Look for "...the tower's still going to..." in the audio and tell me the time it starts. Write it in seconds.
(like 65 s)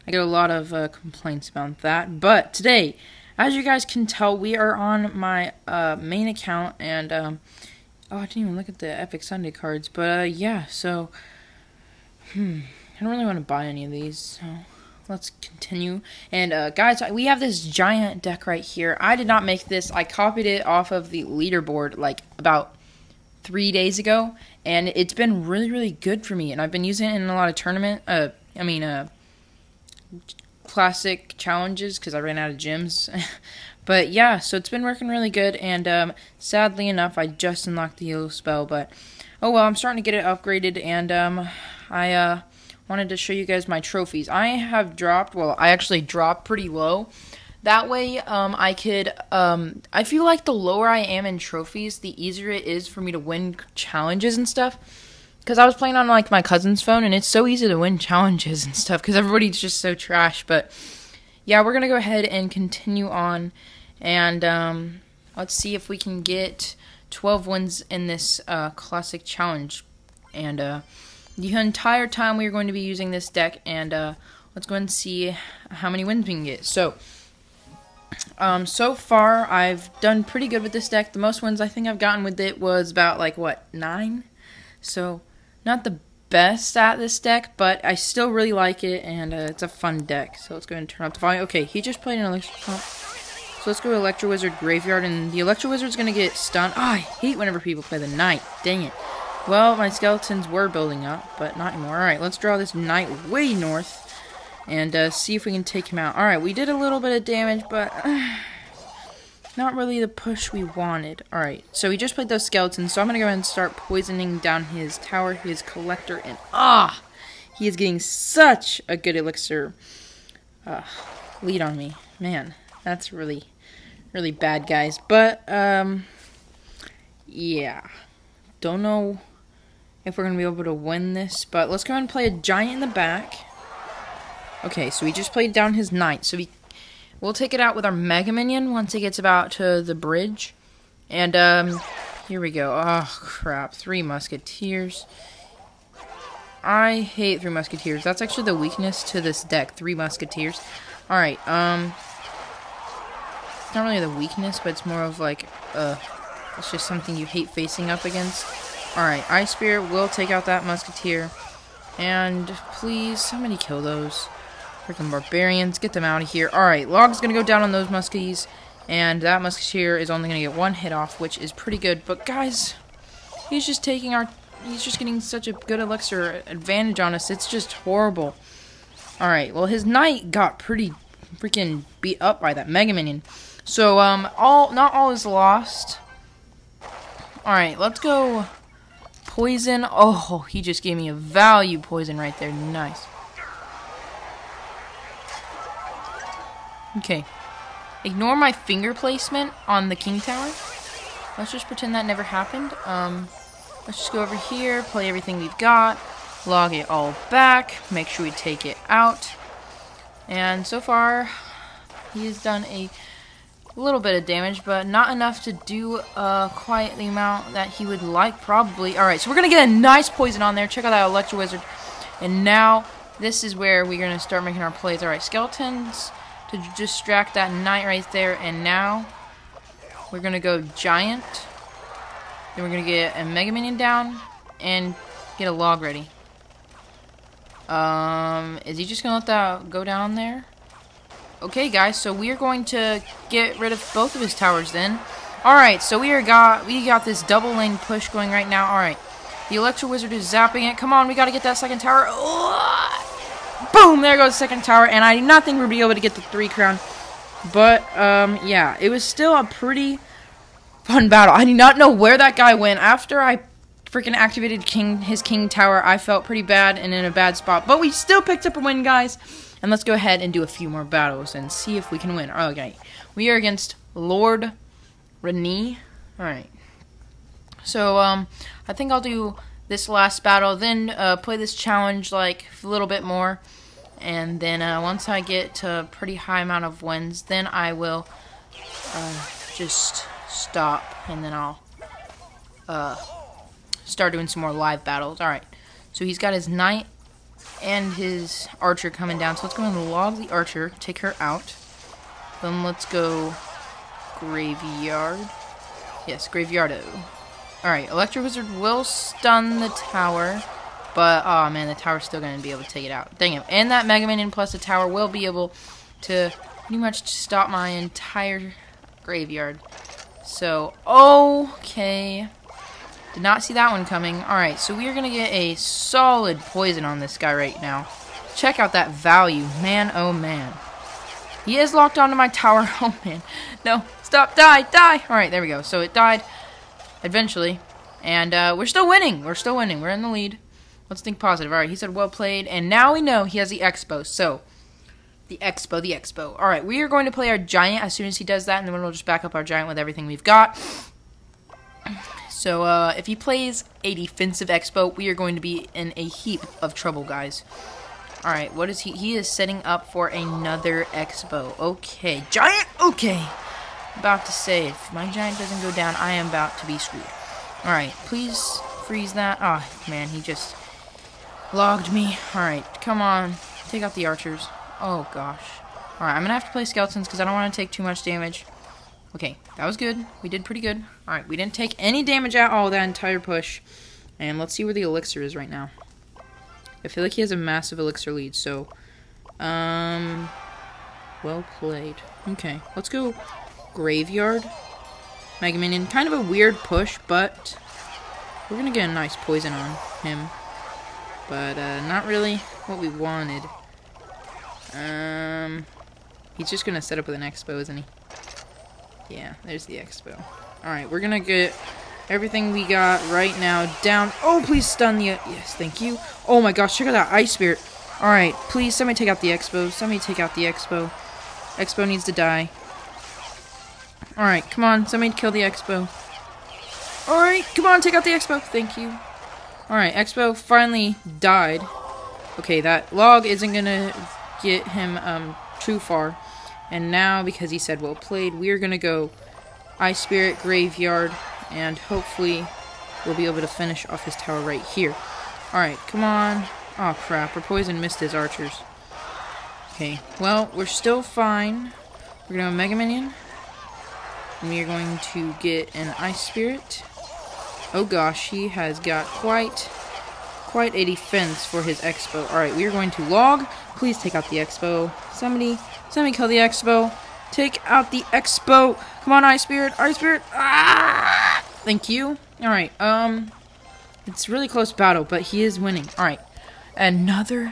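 311 s.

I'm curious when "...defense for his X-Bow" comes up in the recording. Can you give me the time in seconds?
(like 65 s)
460 s.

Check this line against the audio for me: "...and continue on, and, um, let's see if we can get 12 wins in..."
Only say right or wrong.
right.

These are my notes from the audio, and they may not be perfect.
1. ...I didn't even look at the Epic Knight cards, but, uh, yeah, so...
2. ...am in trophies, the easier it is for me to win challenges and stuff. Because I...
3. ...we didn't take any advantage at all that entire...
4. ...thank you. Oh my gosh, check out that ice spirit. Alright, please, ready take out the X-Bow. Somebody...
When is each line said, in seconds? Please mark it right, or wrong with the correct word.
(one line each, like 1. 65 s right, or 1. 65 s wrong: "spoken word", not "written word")
1. 8 s wrong: "Sunday", not "Knight"
2. 50 s right
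3. 381 s wrong: "damage", not "advantage"
4. 415 s wrong: "somebody", not "ready".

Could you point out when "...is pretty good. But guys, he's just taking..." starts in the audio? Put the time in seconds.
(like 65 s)
171 s.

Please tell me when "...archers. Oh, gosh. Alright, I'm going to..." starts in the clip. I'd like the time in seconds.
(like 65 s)
374 s.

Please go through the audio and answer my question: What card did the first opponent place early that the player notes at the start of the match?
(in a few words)
Elixir Pump.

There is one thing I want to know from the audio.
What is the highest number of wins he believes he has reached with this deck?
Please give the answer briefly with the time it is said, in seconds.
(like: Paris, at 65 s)
9, at 83 s.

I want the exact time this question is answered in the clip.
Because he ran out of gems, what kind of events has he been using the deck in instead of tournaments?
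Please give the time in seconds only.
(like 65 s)
30 s.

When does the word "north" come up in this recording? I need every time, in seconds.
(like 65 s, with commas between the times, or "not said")
103 s.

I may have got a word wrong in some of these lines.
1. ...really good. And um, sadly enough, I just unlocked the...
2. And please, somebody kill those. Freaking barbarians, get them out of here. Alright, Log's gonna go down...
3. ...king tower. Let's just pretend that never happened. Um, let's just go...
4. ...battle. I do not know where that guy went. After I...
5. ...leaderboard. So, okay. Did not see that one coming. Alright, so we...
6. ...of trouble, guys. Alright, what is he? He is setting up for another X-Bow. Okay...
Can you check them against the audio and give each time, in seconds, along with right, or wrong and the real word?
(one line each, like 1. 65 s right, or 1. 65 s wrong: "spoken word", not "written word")
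1. 35 s right
2. 161 s right
3. 199 s right
4. 261 s right
5. 319 s wrong: "graveyard", not "leaderboard"
6. 356 s right.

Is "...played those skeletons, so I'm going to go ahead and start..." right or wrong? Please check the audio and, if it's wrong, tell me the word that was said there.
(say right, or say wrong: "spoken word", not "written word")
right.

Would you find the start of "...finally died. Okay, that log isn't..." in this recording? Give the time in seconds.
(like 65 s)
430 s.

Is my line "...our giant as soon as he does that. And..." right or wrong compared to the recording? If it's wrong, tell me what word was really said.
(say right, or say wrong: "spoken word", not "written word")
right.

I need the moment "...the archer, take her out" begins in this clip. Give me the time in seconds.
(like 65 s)
300 s.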